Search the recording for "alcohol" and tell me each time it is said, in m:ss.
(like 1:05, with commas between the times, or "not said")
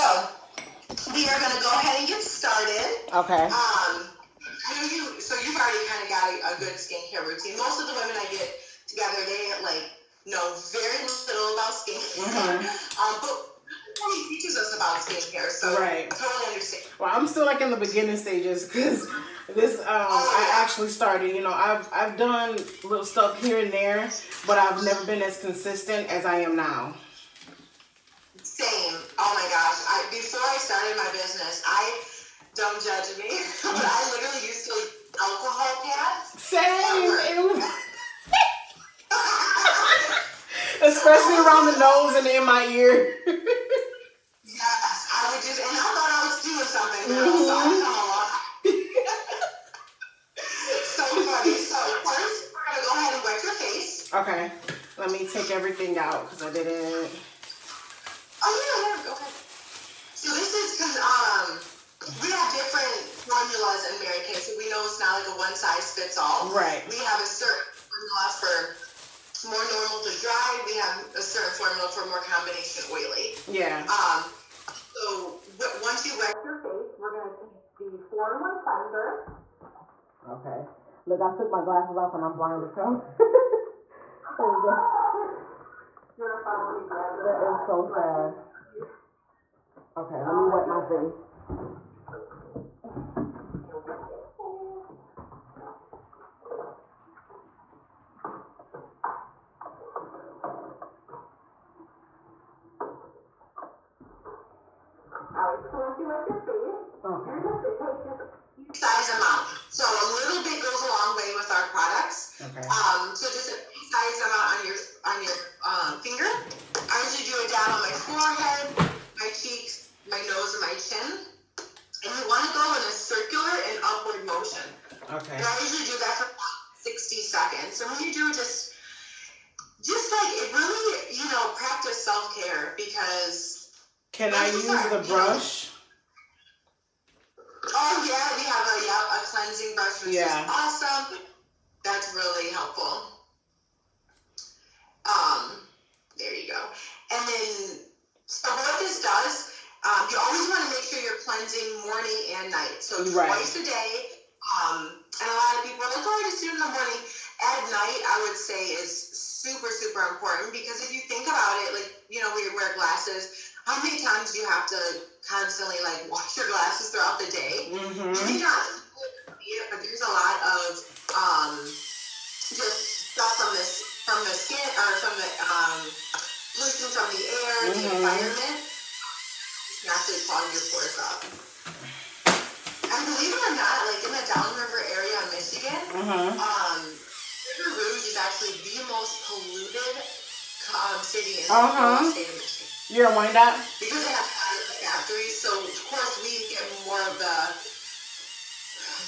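0:35, 0:47.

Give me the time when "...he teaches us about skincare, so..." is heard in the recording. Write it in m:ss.
0:14.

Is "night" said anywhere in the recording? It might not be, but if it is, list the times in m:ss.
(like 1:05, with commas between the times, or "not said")
2:32, 2:37.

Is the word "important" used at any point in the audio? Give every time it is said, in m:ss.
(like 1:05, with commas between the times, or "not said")
2:40.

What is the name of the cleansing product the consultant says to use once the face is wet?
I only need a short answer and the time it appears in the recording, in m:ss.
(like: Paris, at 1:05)
4 in 1 cleanser, at 1:17.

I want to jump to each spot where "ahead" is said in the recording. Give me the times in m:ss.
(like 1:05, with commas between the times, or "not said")
0:01, 0:53.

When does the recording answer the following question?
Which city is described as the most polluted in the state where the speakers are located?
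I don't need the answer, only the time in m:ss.
3:07.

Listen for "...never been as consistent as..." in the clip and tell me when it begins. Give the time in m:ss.
0:24.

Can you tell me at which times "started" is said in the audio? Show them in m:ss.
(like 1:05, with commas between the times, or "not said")
0:02, 0:20, 0:30.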